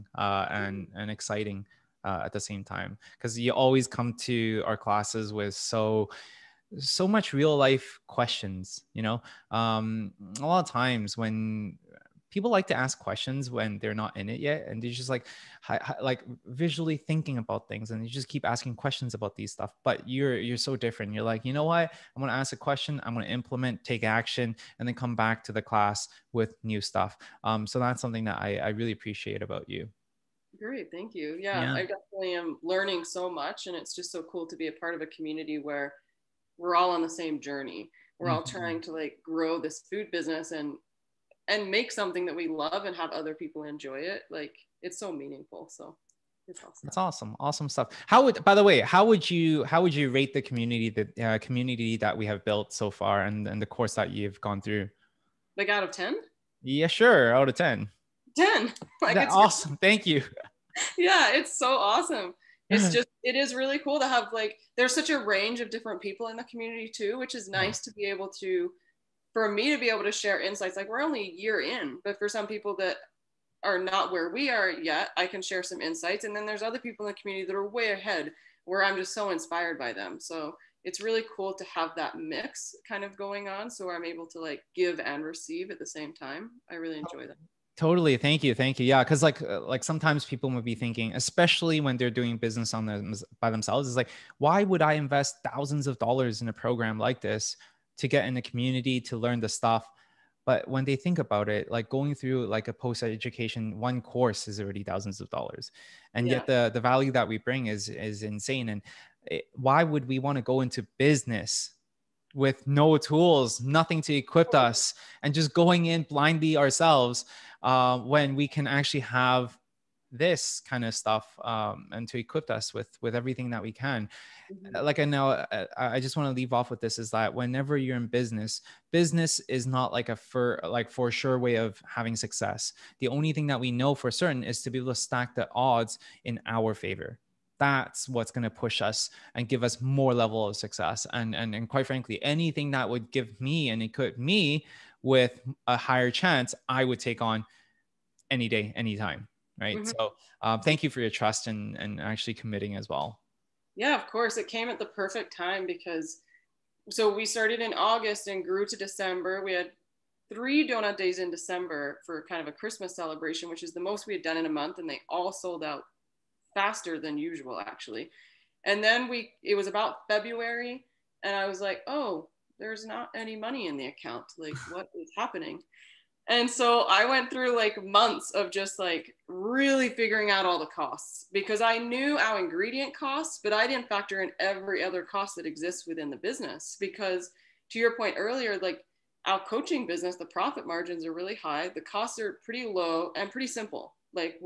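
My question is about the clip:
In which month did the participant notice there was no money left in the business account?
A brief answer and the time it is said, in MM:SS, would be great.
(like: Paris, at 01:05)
February, at 02:50.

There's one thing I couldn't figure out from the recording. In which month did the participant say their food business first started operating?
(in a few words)
August.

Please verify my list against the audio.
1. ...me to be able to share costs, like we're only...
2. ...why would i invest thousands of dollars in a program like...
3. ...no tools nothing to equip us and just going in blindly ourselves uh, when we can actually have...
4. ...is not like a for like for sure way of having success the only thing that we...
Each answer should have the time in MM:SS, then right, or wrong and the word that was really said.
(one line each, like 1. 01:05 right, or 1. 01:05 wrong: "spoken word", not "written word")
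1. 01:09 wrong: "insights", not "costs"
2. 01:34 right
3. 01:52 right
4. 02:09 right.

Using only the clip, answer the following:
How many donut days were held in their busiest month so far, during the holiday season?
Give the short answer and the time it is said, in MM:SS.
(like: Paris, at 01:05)
3, at 02:40.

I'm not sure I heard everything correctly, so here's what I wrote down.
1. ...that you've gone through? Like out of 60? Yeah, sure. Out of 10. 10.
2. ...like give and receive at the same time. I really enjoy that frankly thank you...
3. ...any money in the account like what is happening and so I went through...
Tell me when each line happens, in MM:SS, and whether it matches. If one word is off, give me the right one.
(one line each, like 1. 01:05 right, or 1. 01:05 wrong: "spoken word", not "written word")
1. 00:53 wrong: "10", not "60"
2. 01:24 wrong: "totally", not "frankly"
3. 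02:53 right.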